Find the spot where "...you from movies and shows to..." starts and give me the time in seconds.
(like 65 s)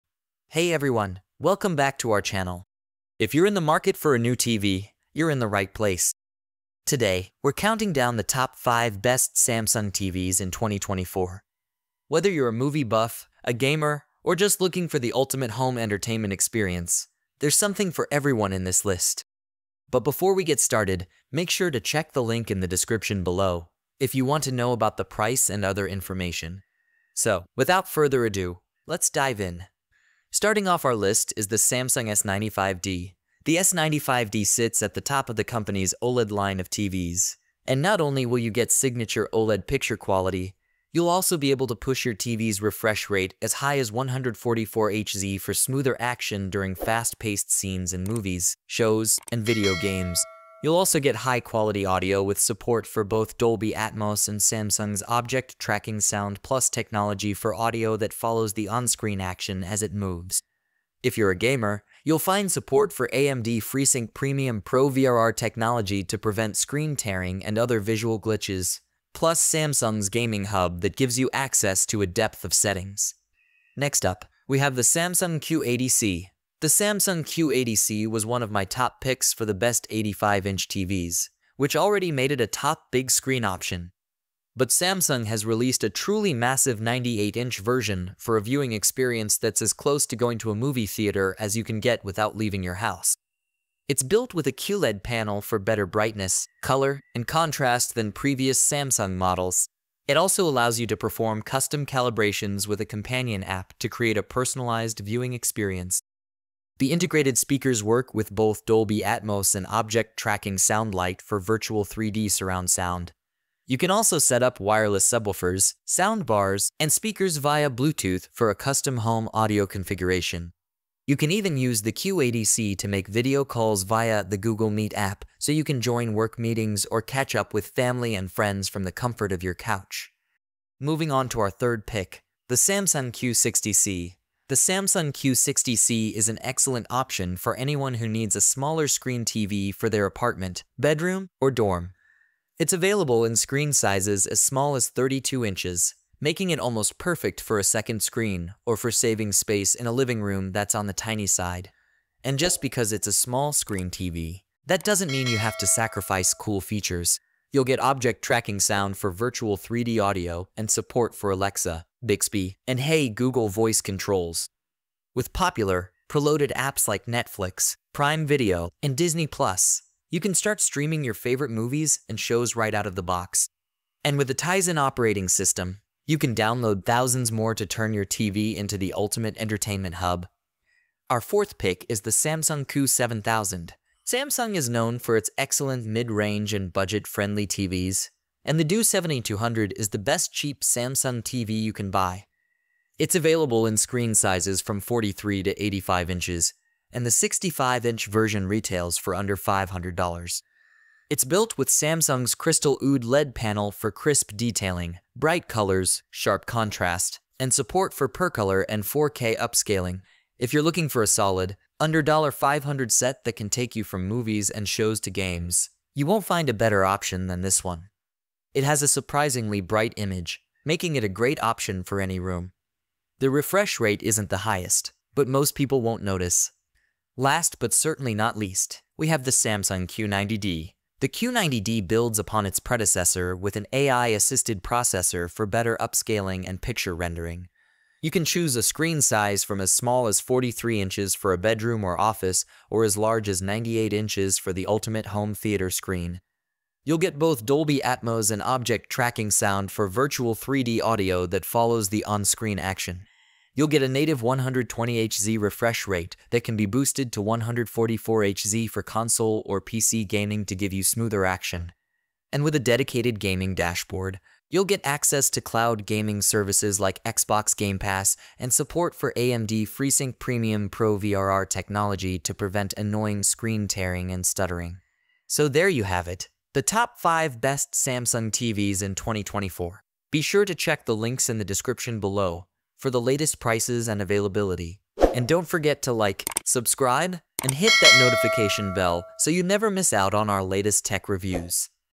213 s.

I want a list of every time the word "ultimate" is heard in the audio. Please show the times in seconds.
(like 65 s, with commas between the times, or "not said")
15 s, 178 s, 244 s.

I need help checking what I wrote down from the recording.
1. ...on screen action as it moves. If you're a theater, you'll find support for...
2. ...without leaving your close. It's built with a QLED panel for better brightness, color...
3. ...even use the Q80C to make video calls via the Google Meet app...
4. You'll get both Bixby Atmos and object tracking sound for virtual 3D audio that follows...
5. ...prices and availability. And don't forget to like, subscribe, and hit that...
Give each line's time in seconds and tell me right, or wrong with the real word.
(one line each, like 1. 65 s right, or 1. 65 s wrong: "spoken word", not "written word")
1. 58 s wrong: "gamer", not "theater"
2. 92 s wrong: "house", not "close"
3. 121 s right
4. 246 s wrong: "Dolby", not "Bixby"
5. 283 s right.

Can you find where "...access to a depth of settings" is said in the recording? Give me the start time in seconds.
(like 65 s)
71 s.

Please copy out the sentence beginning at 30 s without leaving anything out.
Starting off our list is the Samsung S95D.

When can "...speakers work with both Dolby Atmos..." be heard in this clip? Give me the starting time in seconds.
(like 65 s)
107 s.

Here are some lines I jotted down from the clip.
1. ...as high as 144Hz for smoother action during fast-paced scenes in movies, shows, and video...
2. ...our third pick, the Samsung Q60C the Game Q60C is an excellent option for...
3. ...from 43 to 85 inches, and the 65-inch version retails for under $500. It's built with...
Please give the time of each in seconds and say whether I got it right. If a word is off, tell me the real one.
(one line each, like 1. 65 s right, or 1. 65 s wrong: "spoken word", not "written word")
1. 43 s right
2. 131 s wrong: "Samsung", not "Game"
3. 194 s right.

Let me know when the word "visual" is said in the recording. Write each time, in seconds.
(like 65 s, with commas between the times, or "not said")
67 s.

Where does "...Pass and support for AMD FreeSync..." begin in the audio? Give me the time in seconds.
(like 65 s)
267 s.